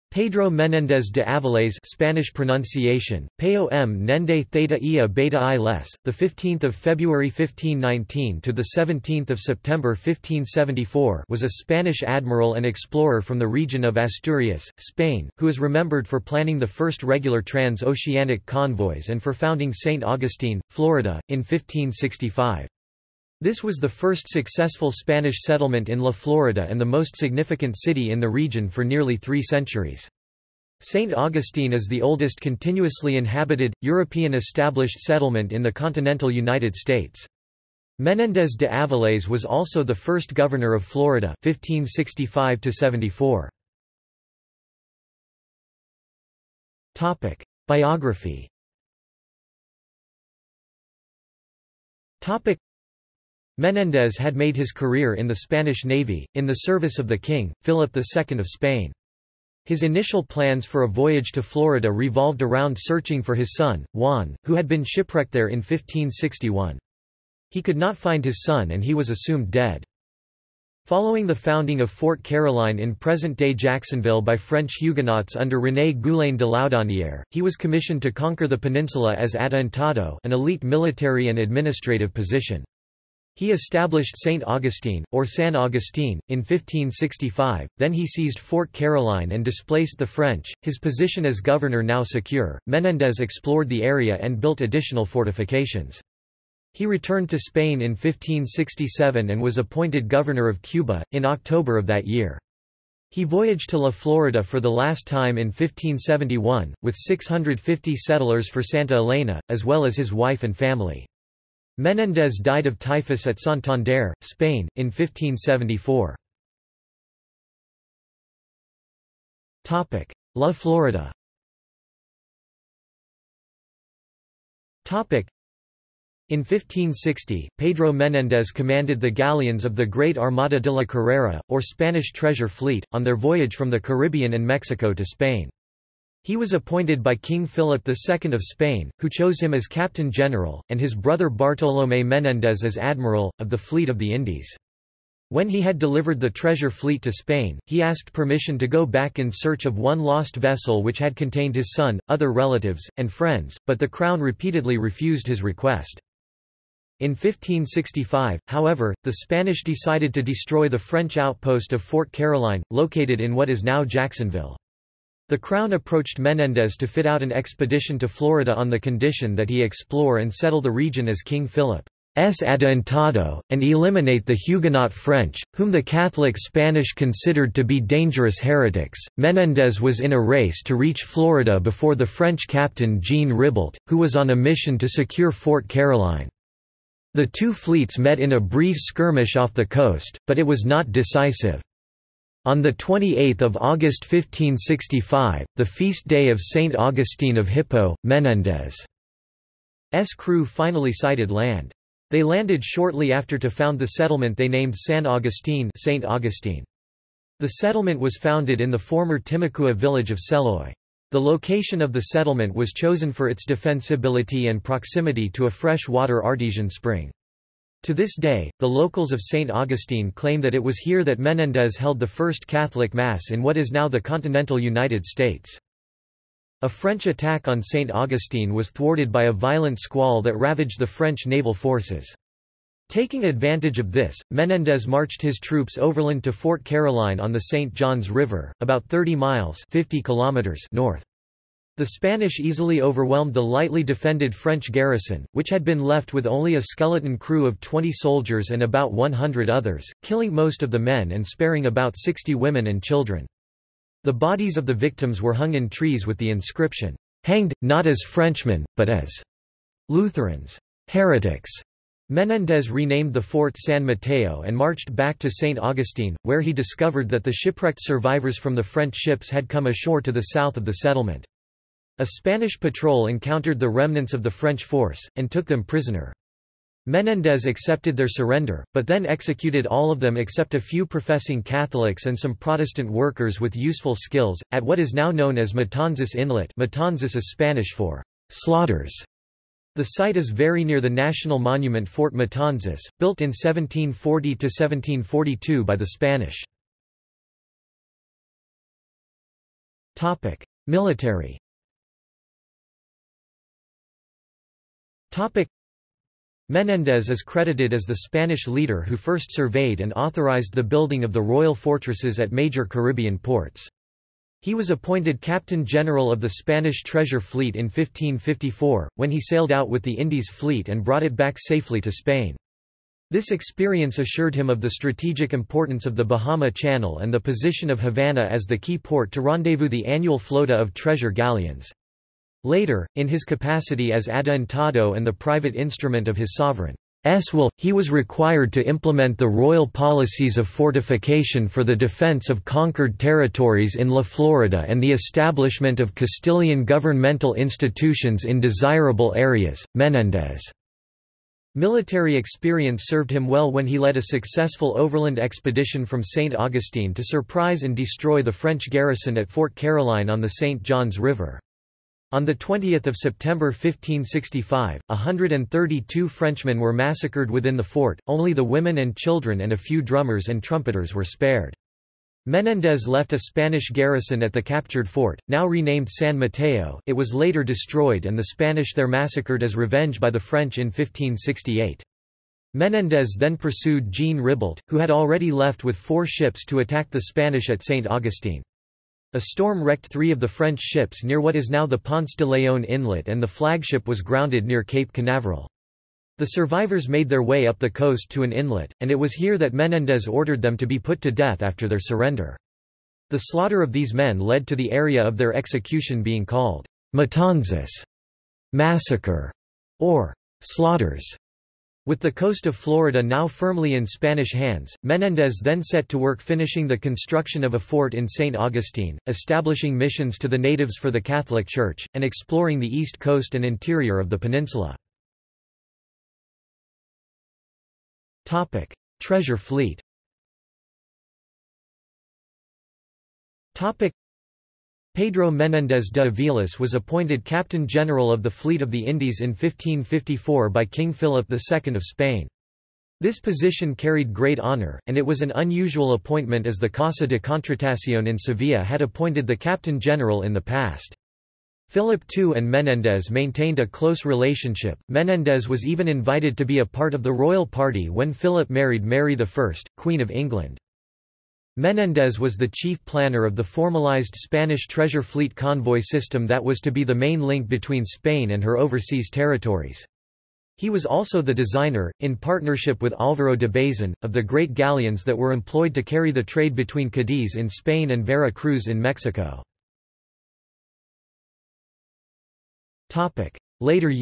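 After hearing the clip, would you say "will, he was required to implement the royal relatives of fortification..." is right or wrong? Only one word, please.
wrong.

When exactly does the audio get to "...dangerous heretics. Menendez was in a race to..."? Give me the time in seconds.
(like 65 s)
177 s.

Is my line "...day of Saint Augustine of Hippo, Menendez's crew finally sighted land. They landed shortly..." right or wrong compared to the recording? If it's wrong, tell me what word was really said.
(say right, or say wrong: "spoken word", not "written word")
right.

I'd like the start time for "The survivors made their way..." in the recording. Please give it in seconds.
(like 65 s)
396 s.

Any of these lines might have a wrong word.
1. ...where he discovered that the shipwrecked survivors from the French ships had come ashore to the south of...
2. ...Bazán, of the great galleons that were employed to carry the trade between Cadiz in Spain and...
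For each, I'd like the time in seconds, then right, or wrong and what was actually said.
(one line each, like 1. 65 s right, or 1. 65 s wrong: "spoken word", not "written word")
1. 266 s right
2. 473 s right.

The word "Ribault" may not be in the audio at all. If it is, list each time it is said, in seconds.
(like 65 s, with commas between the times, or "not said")
183 s, 384 s.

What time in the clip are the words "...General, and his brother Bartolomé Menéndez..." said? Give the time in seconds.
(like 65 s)
140 s.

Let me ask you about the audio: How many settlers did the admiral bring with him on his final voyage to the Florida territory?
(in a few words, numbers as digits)
650.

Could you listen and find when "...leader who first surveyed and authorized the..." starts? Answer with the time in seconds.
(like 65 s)
308 s.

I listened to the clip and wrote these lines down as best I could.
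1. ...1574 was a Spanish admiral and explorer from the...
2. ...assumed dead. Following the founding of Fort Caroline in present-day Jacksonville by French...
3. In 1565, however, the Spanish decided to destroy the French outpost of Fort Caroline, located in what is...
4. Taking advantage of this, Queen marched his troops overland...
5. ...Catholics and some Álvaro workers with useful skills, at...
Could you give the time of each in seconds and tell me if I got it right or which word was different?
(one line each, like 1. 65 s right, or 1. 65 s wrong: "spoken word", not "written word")
1. 9 s right
2. 69 s right
3. 157 s right
4. 232 s wrong: "Menendez", not "Queen"
5. 281 s wrong: "Protestant", not "Álvaro".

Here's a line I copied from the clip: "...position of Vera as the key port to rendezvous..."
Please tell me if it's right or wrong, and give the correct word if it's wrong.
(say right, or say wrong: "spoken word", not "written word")
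wrong: "Havana", not "Vera".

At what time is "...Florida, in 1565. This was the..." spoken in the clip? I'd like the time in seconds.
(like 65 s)
20 s.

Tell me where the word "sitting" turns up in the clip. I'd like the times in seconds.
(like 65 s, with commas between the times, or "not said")
not said.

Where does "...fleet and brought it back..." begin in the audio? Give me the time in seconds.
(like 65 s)
320 s.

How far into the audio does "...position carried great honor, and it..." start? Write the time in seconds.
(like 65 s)
443 s.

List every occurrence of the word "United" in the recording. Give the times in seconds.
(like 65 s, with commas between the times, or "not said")
36 s, 224 s.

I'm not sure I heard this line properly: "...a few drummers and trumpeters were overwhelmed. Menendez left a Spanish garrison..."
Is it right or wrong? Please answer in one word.
wrong.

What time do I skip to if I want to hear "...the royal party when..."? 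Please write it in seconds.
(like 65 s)
457 s.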